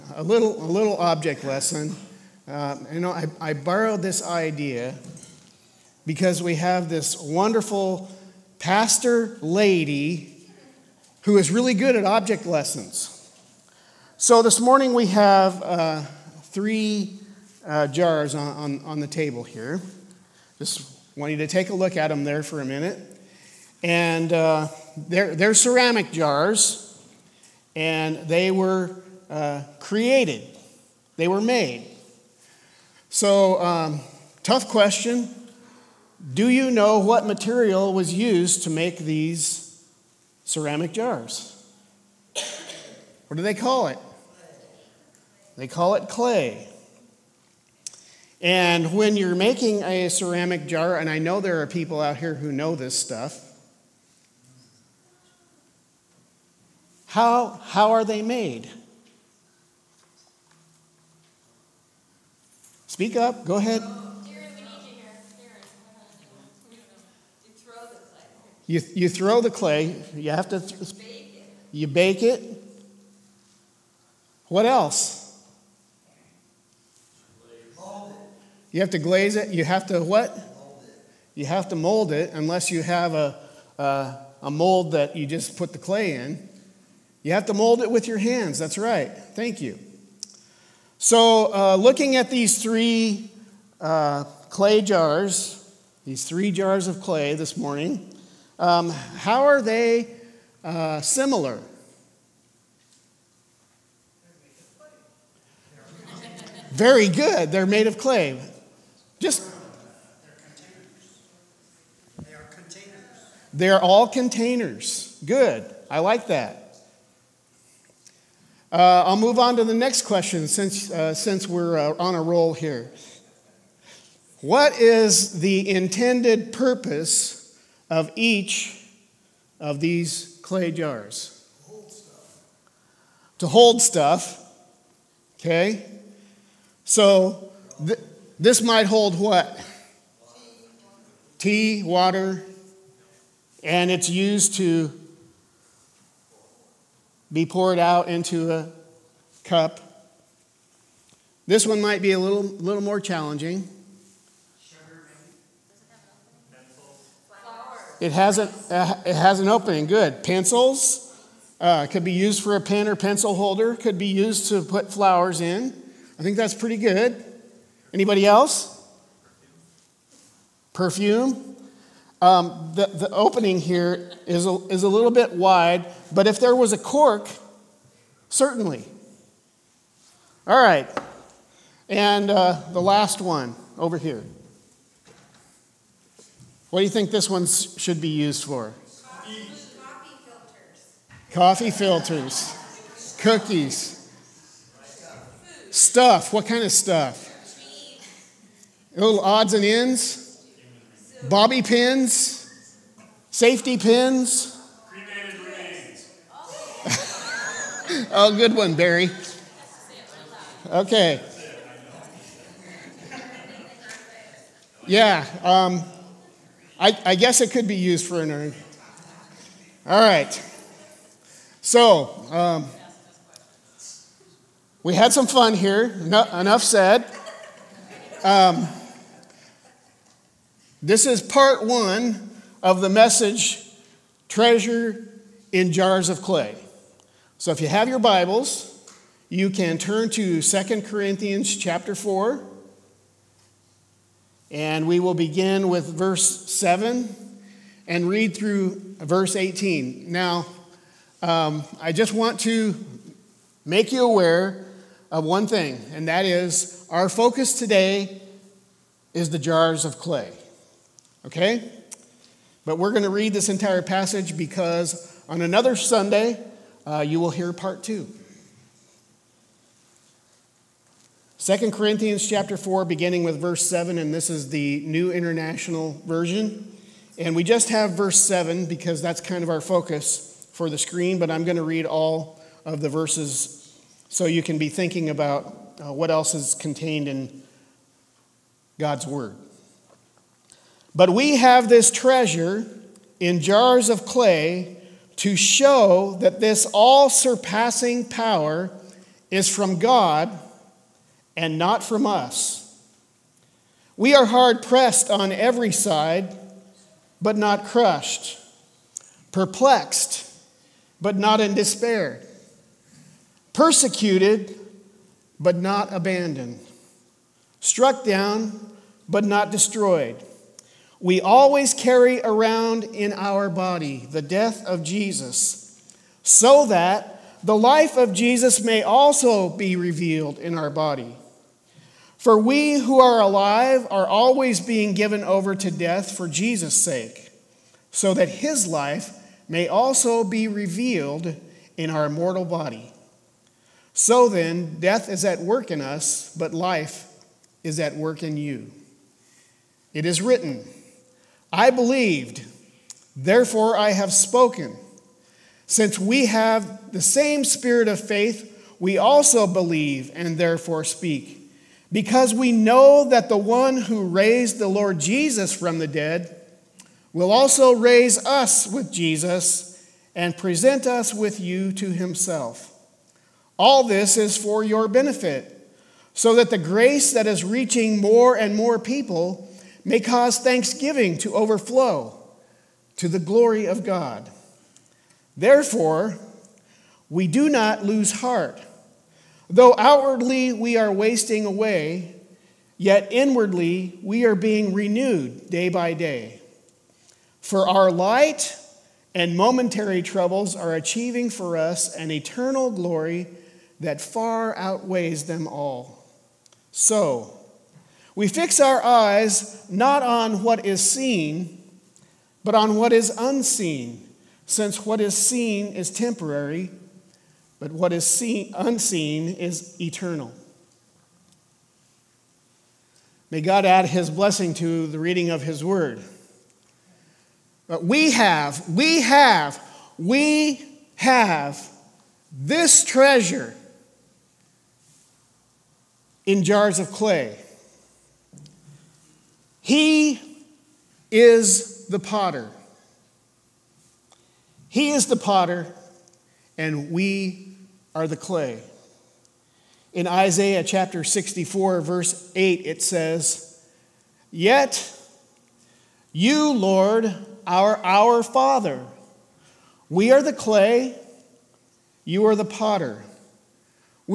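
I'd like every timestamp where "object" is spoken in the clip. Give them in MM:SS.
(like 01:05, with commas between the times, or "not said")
00:00, 00:12.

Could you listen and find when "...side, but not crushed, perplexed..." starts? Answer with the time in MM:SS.
05:05.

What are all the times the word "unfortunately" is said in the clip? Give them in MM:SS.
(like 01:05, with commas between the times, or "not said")
not said.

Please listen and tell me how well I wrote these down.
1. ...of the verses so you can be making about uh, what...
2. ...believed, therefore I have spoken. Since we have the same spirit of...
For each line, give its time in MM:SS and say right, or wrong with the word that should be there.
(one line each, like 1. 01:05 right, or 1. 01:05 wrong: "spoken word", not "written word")
1. 04:42 wrong: "thinking", not "making"
2. 05:51 right.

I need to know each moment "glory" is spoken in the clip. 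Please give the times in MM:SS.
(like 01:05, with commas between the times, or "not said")
06:23, 06:42.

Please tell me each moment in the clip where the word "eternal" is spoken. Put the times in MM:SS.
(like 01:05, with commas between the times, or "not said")
06:42, 06:59.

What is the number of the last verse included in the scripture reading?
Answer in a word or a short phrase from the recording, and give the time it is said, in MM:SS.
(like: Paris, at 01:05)
18, at 04:08.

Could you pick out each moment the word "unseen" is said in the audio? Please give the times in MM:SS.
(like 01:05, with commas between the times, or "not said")
06:53, 06:58.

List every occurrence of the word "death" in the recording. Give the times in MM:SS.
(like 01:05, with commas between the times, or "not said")
05:24, 05:35, 05:44.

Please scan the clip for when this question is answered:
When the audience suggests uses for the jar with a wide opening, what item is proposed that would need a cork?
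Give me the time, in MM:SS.
02:50.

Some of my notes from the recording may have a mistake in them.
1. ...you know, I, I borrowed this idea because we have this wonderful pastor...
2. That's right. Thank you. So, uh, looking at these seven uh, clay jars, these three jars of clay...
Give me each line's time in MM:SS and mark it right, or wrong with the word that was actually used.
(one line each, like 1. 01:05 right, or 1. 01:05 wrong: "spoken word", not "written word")
1. 00:02 right
2. 01:28 wrong: "three", not "seven".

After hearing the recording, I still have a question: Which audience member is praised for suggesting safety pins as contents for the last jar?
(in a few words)
Barry.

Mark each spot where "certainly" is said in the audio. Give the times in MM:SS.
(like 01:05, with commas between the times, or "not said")
02:58.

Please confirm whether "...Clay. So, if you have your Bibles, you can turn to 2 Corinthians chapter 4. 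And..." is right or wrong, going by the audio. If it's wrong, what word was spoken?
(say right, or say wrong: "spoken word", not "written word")
right.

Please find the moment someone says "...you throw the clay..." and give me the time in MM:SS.
01:08.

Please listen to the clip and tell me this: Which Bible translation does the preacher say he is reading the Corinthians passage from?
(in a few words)
New International Version.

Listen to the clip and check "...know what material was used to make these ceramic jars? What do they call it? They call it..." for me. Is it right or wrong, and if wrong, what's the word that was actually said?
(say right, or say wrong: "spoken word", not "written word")
right.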